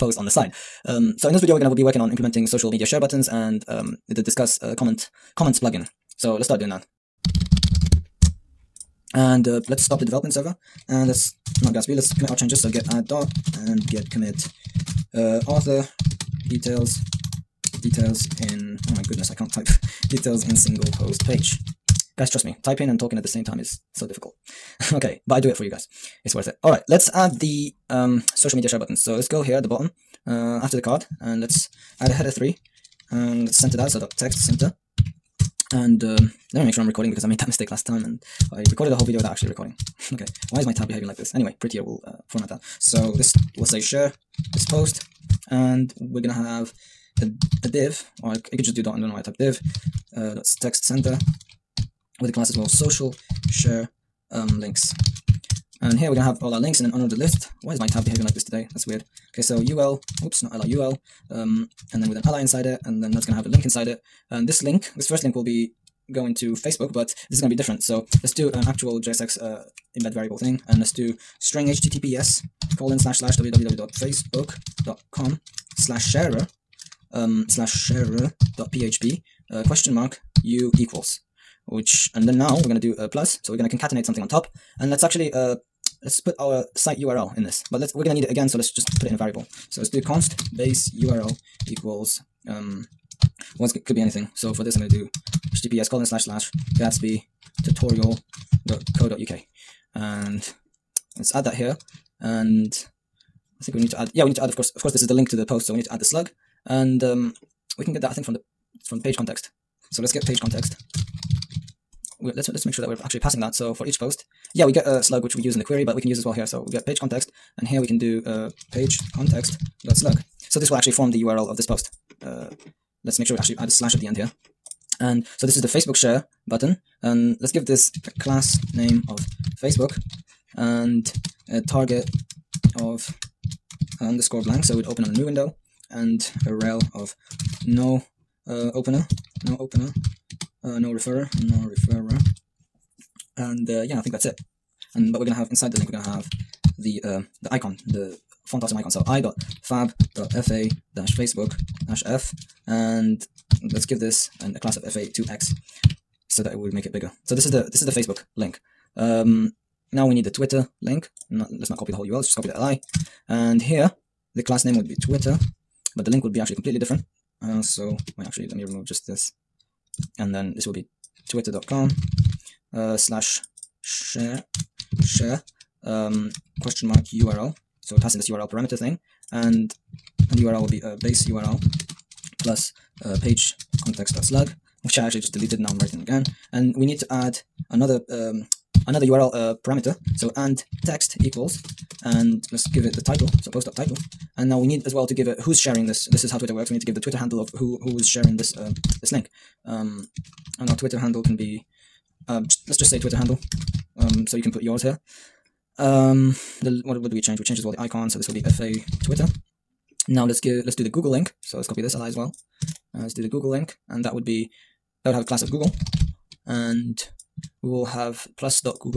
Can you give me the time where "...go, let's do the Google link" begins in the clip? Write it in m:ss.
3:30.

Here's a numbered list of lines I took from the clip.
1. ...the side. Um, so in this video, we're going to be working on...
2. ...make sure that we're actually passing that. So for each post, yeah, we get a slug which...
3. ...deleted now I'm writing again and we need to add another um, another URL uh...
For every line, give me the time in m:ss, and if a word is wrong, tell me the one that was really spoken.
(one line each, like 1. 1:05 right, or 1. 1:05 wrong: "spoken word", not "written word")
1. 0:00 right
2. 1:52 right
3. 3:05 right.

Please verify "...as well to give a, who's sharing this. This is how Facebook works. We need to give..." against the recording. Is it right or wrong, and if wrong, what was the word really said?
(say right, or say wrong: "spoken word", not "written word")
wrong: "Twitter", not "Facebook".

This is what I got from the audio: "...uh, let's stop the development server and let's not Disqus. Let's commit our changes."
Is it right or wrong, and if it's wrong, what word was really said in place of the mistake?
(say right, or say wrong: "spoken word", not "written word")
wrong: "Gatsby", not "Disqus".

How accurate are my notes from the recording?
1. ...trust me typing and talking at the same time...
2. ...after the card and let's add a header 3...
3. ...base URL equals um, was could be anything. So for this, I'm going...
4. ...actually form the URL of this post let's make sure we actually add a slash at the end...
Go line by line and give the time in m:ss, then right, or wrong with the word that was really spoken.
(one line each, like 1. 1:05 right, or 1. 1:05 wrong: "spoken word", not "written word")
1. 0:22 right
2. 0:30 right
3. 1:30 right
4. 2:00 right.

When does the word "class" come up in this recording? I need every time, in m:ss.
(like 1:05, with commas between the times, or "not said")
0:52, 2:08, 2:34, 2:44, 3:35.